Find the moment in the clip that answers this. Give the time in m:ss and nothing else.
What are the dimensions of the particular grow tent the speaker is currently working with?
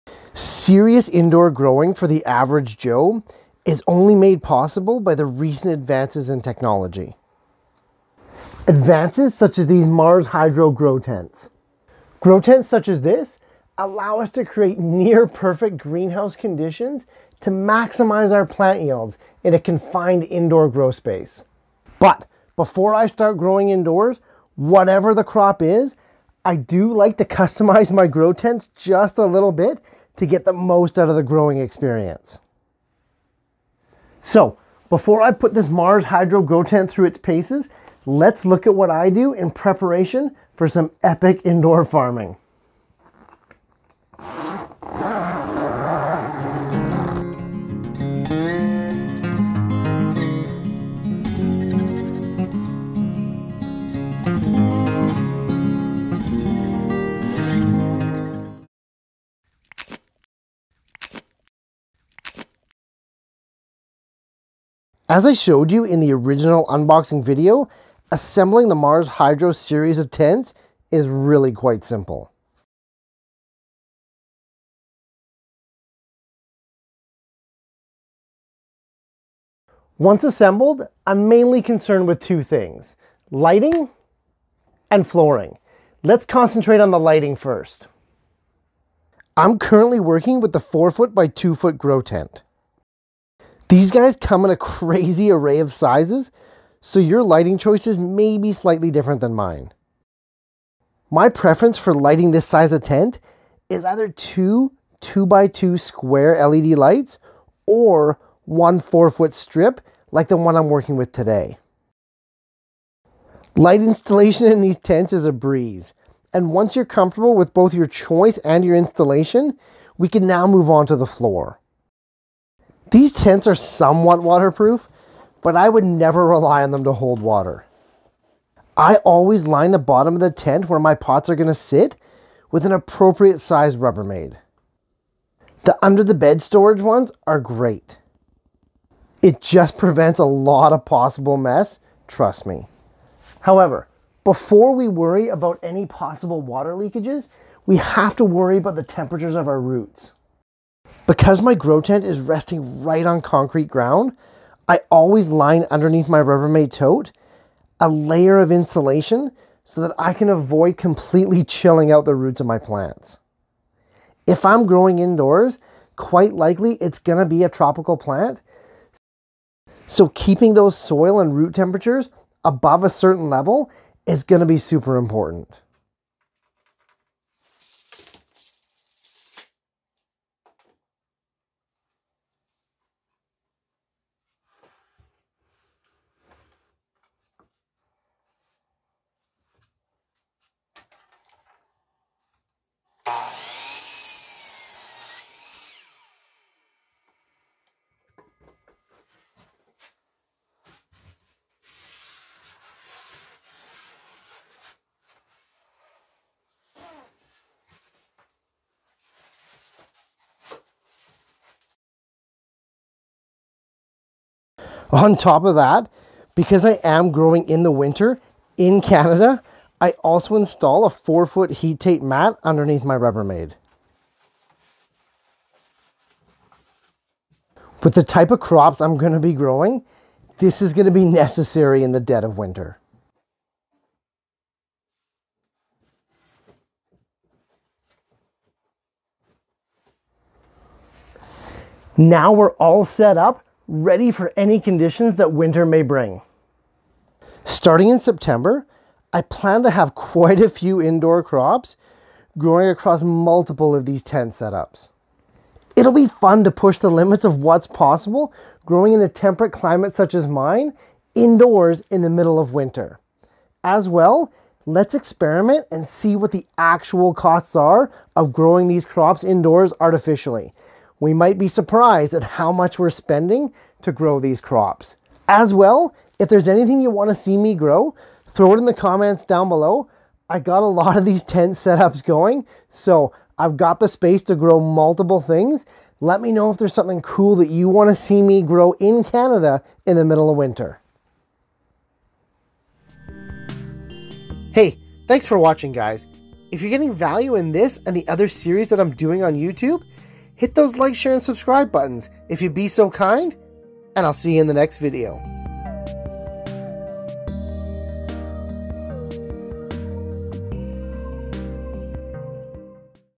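1:30.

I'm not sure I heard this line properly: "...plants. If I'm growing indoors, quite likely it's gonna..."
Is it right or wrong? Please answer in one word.
right.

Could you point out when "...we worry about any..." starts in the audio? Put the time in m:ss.
2:24.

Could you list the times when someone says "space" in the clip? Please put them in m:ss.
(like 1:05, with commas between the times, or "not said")
0:20, 4:43.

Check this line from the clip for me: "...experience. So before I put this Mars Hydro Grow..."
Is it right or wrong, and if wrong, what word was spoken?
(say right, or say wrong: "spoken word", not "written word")
right.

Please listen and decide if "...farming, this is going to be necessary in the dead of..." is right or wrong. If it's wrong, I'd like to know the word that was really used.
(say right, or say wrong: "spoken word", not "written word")
wrong: "growing", not "farming".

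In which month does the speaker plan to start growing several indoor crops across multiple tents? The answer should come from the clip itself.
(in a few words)
September.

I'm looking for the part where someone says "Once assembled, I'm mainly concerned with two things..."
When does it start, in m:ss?
1:19.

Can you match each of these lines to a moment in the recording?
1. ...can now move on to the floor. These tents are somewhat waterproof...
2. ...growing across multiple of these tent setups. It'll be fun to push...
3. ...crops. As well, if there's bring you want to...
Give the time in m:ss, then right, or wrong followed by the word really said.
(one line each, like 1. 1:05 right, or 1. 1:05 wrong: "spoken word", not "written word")
1. 2:00 right
2. 4:12 right
3. 4:34 wrong: "anything", not "bring".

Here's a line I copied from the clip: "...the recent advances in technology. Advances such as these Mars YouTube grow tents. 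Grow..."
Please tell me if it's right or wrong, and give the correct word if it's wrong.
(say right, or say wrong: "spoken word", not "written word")
wrong: "Hydro", not "YouTube".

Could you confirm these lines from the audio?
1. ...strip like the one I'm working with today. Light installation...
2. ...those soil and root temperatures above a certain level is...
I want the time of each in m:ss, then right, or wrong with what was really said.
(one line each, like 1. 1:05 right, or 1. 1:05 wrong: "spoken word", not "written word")
1. 1:49 right
2. 2:50 right.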